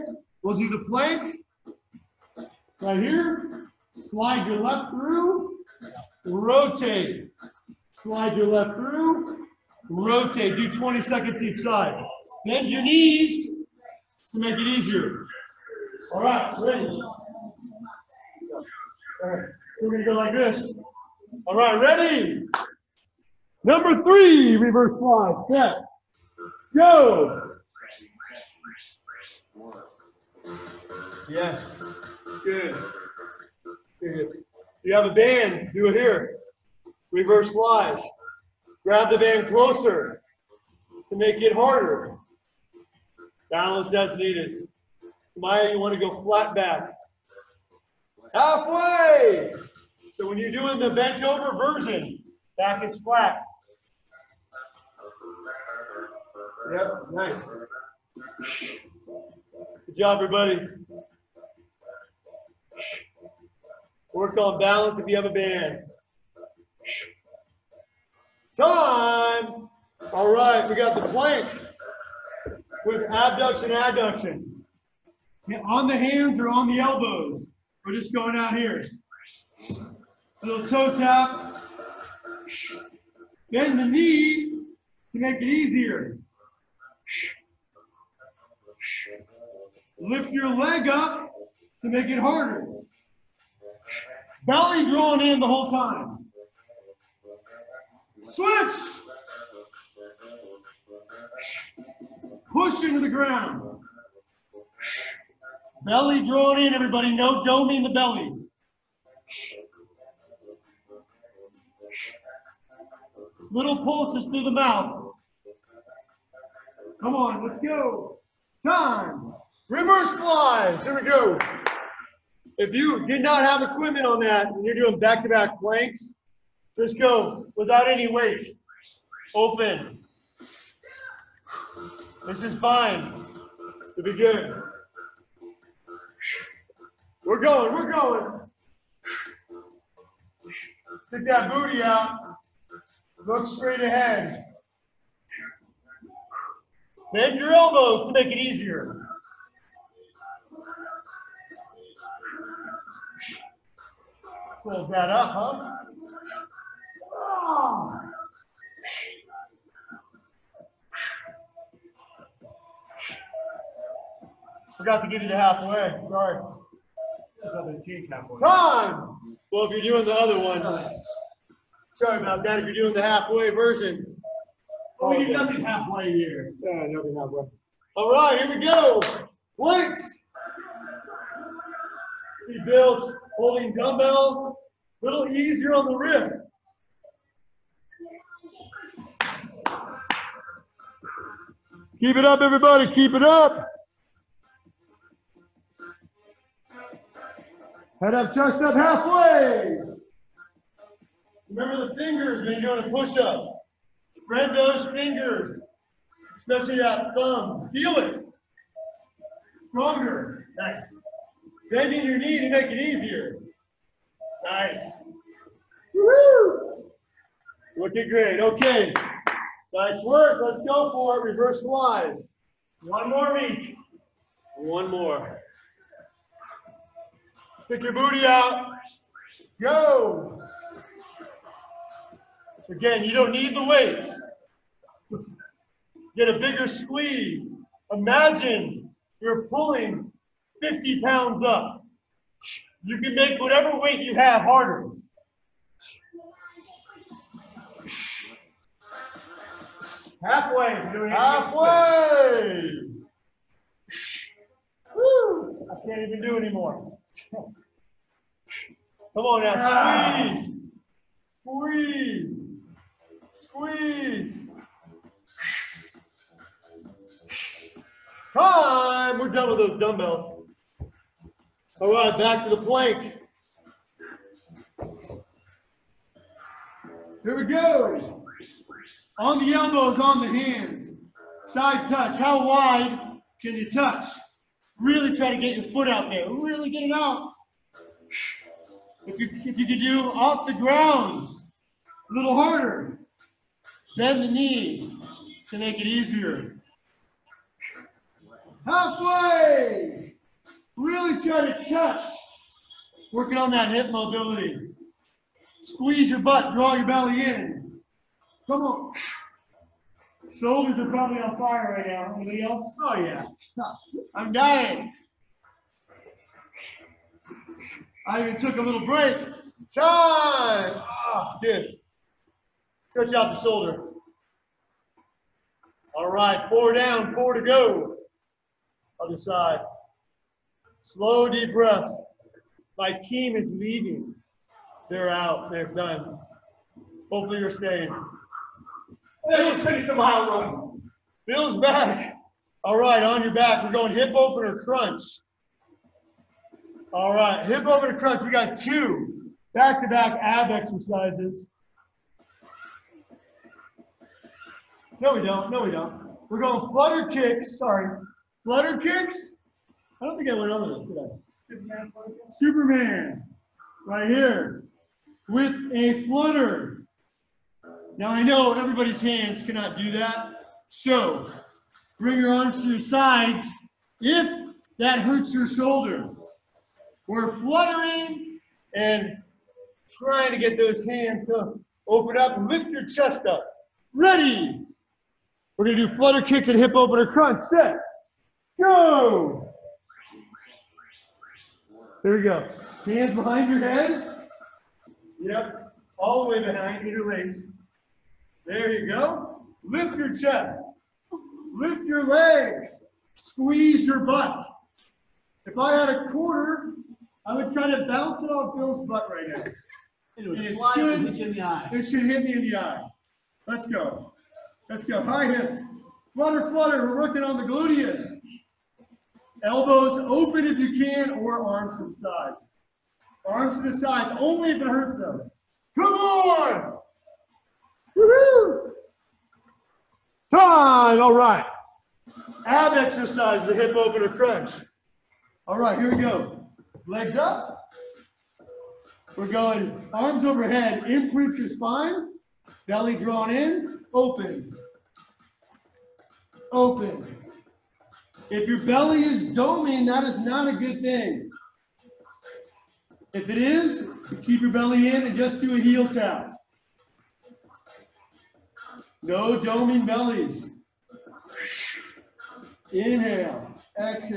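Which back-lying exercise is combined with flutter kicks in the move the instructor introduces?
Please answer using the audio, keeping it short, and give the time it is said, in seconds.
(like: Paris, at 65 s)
Superman, at 362 s.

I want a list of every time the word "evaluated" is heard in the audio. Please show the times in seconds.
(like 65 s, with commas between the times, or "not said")
not said.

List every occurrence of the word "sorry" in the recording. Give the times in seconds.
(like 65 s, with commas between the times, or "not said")
166 s, 171 s, 357 s.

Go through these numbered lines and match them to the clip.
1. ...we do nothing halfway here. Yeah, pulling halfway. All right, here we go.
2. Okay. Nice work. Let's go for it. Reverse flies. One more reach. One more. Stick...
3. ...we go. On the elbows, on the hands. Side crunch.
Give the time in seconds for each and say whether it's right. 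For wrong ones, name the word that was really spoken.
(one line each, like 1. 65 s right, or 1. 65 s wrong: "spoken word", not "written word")
1. 175 s wrong: "nothing", not "pulling"
2. 218 s right
3. 277 s wrong: "touch", not "crunch".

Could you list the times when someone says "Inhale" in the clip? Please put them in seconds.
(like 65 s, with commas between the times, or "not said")
462 s.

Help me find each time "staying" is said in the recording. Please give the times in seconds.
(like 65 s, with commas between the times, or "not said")
337 s.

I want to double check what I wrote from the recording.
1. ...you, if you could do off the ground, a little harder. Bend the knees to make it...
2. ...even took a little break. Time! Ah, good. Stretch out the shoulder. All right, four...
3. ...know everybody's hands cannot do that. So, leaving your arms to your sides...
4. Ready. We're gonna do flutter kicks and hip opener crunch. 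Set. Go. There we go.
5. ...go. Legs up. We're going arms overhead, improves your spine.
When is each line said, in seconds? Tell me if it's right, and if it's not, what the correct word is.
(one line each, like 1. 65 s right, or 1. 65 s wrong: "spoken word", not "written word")
1. 289 s right
2. 318 s right
3. 368 s wrong: "bring", not "leaving"
4. 383 s right
5. 436 s right.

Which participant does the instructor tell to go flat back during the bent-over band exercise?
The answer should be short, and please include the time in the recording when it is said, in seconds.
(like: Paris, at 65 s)
Maya, at 45 s.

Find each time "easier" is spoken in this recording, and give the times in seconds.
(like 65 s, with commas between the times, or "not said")
14 s, 85 s, 148 s, 185 s, 212 s, 295 s.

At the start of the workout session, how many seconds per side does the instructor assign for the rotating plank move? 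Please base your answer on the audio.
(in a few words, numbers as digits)
20 seconds.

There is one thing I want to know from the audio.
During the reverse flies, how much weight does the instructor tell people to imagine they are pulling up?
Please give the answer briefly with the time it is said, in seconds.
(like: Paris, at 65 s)
50 pounds, at 240 s.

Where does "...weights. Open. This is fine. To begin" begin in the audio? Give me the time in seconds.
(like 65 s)
128 s.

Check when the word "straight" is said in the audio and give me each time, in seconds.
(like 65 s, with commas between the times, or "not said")
143 s.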